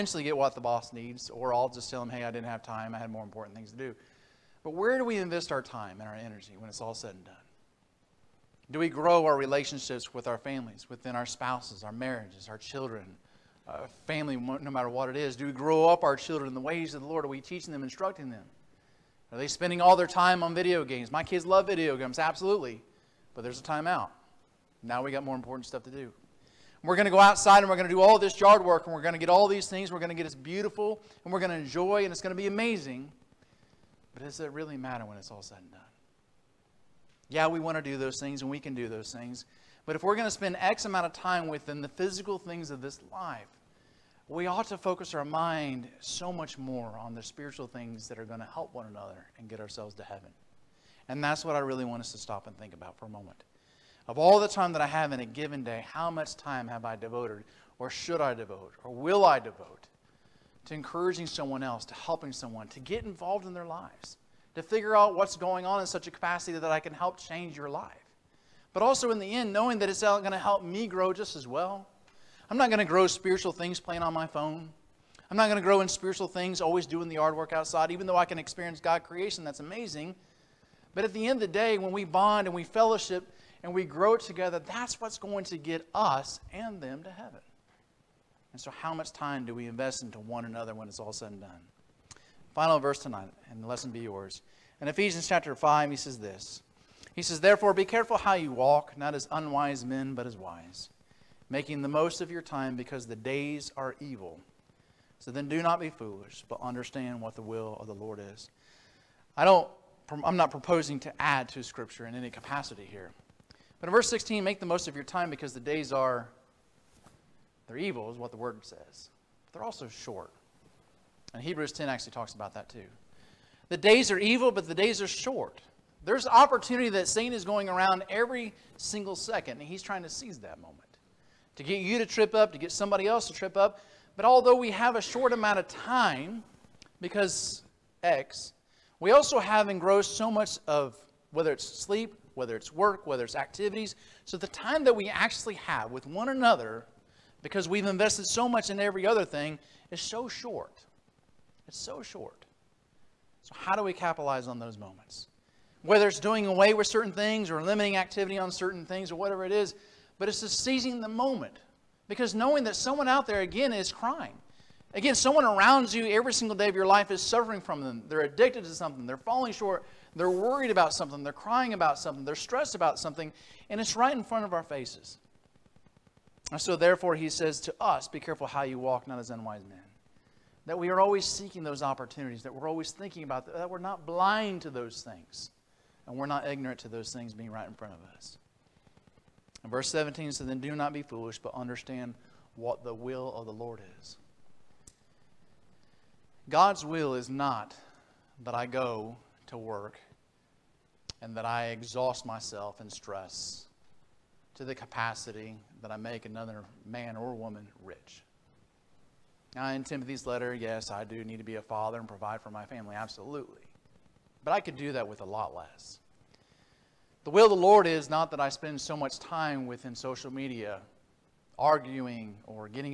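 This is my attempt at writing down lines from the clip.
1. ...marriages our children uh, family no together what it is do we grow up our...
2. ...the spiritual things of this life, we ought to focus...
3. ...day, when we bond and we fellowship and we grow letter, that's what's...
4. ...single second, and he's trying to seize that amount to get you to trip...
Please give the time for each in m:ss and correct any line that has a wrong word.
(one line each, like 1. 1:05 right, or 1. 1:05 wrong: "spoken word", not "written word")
1. 0:11 wrong: "matter", not "together"
2. 0:41 wrong: "physical", not "spiritual"
3. 1:21 wrong: "together", not "letter"
4. 2:08 wrong: "moment", not "amount".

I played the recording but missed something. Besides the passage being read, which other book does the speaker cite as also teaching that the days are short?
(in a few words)
Hebrews.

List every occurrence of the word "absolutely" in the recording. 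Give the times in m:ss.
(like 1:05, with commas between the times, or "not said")
0:22, 3:32.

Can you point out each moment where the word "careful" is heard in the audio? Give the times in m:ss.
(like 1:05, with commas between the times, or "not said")
1:37, 2:58.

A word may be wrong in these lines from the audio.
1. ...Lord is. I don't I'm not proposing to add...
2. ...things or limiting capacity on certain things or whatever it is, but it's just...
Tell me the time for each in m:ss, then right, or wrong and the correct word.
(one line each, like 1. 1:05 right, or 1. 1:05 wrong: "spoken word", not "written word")
1. 1:47 right
2. 2:37 wrong: "activity", not "capacity".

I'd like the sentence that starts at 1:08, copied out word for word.
But also in the end, knowing that it's going to help me grow just as well.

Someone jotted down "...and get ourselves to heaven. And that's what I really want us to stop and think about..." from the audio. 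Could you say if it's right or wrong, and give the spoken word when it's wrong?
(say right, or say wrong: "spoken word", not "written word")
right.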